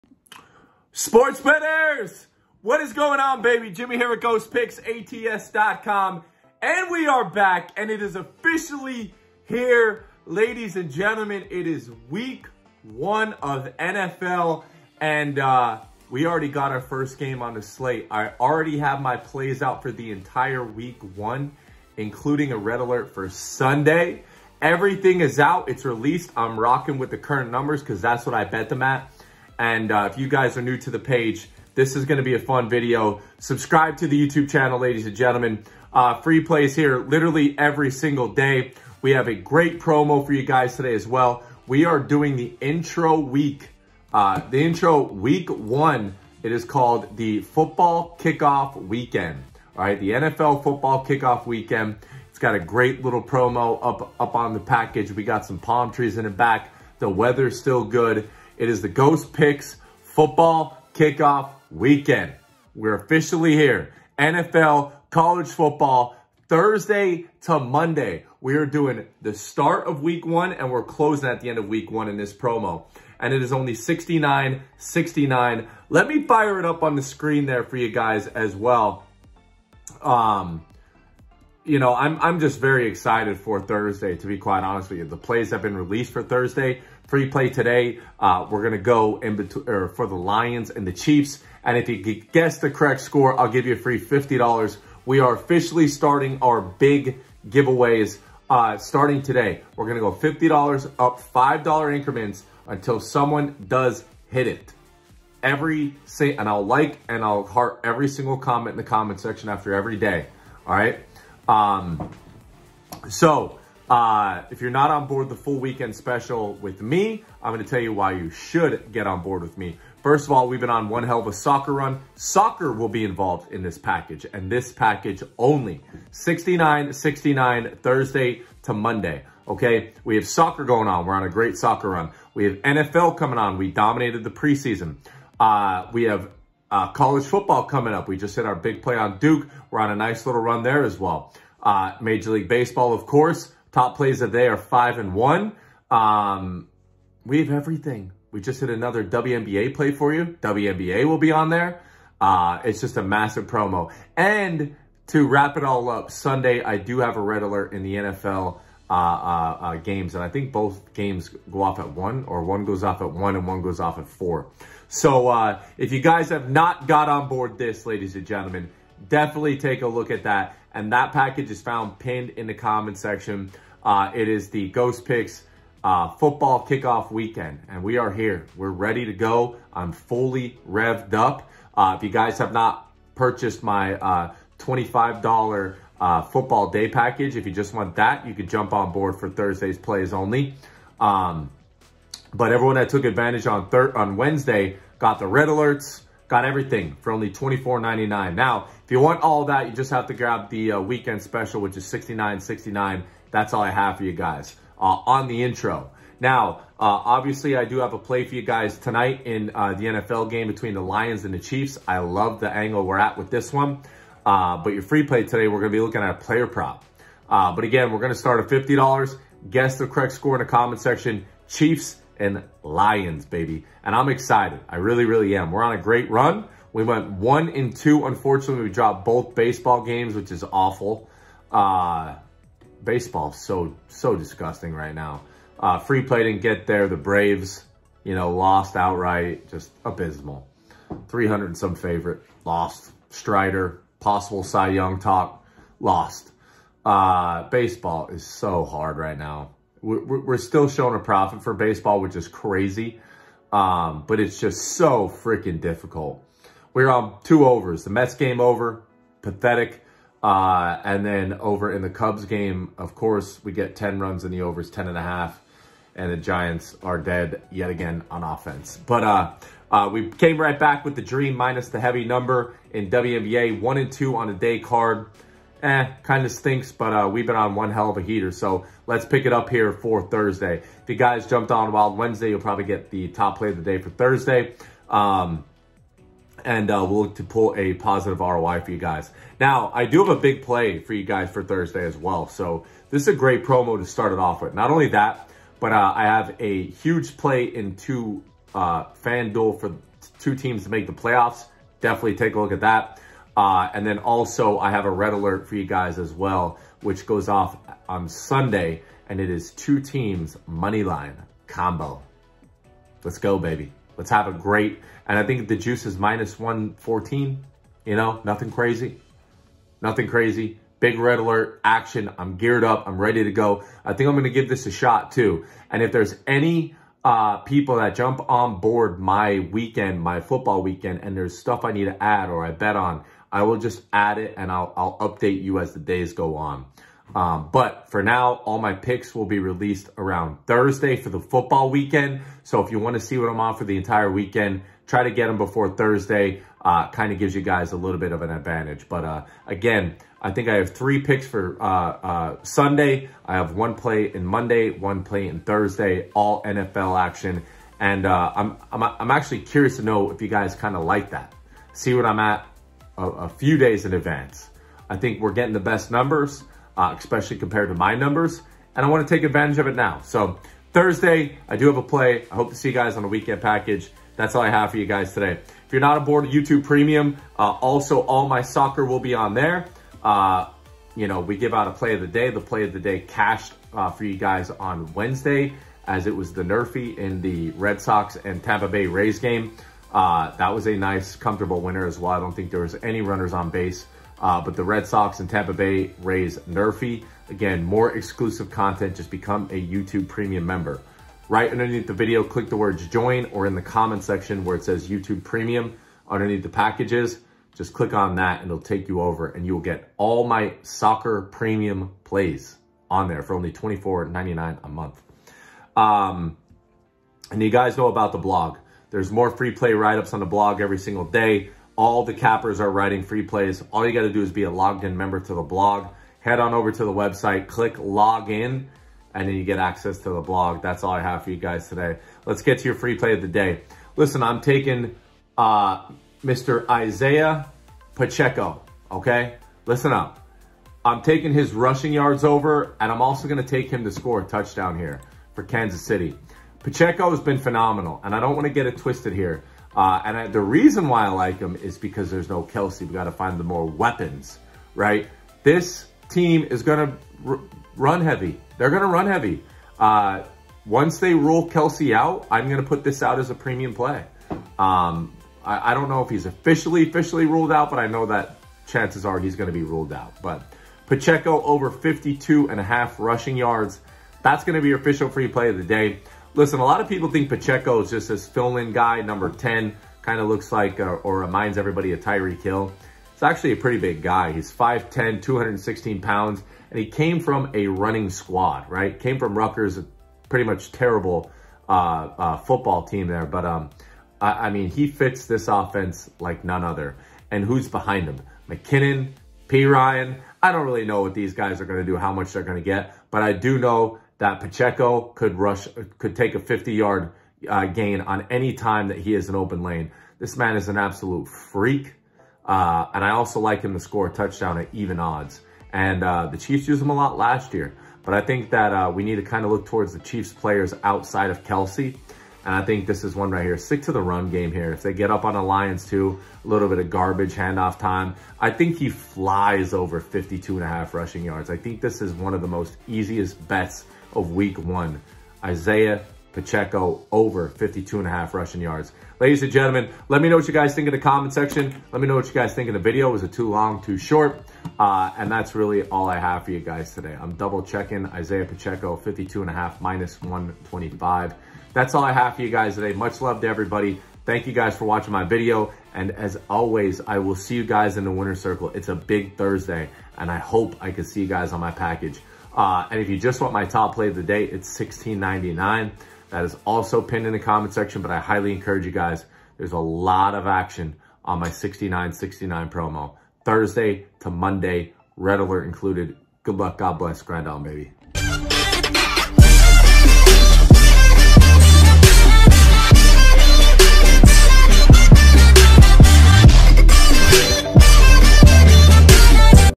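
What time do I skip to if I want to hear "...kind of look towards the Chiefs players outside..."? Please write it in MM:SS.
08:39.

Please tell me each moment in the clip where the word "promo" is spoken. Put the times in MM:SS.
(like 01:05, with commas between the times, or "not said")
00:39, 00:53, 01:12, 02:33, 04:53, 09:32.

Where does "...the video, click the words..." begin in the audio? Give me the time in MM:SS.
06:41.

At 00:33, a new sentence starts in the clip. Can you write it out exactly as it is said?
Subscribe to the YouTube channel, ladies and gentlemen.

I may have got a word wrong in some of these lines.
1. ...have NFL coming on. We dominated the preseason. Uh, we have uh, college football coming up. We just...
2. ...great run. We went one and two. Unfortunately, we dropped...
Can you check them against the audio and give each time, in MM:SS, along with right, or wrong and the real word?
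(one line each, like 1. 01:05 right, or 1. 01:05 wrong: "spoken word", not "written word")
1. 02:12 right
2. 03:45 right.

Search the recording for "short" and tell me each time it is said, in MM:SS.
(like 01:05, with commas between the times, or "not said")
09:03.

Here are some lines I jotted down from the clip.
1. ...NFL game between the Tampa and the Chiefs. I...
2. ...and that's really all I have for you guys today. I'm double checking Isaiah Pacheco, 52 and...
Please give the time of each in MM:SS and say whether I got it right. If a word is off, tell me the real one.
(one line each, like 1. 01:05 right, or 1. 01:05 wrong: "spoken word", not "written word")
1. 03:29 wrong: "Lions", not "Tampa"
2. 09:05 right.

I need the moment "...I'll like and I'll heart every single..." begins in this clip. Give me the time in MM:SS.
01:46.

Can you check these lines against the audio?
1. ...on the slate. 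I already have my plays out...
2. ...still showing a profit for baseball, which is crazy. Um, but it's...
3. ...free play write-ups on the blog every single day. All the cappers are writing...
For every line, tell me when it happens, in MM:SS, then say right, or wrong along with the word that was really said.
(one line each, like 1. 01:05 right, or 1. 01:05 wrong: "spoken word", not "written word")
1. 00:17 right
2. 04:10 right
3. 06:59 right.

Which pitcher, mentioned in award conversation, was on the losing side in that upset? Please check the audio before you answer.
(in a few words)
Strider.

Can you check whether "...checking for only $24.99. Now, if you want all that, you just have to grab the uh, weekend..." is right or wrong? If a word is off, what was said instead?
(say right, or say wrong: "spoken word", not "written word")
wrong: "everything", not "checking".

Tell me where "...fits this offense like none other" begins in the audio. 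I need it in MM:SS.
08:14.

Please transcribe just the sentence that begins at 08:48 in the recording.
I think he flies over 52 and a half rushing yards.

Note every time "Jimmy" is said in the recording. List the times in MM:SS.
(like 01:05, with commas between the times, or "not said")
00:03.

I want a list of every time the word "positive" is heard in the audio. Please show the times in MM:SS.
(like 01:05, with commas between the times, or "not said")
04:47.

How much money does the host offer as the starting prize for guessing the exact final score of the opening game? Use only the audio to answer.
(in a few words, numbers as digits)
$50.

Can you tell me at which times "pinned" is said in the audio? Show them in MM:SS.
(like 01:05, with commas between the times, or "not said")
02:51, 09:27.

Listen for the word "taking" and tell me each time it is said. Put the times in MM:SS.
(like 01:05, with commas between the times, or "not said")
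07:14, 07:21.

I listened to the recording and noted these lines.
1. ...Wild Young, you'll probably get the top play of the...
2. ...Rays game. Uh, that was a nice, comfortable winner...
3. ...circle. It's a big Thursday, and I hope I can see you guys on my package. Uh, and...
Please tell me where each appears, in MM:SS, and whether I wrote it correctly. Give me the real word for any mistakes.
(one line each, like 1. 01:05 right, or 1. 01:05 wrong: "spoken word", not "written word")
1. 04:41 wrong: "Wednesday", not "Young"
2. 06:28 right
3. 09:18 right.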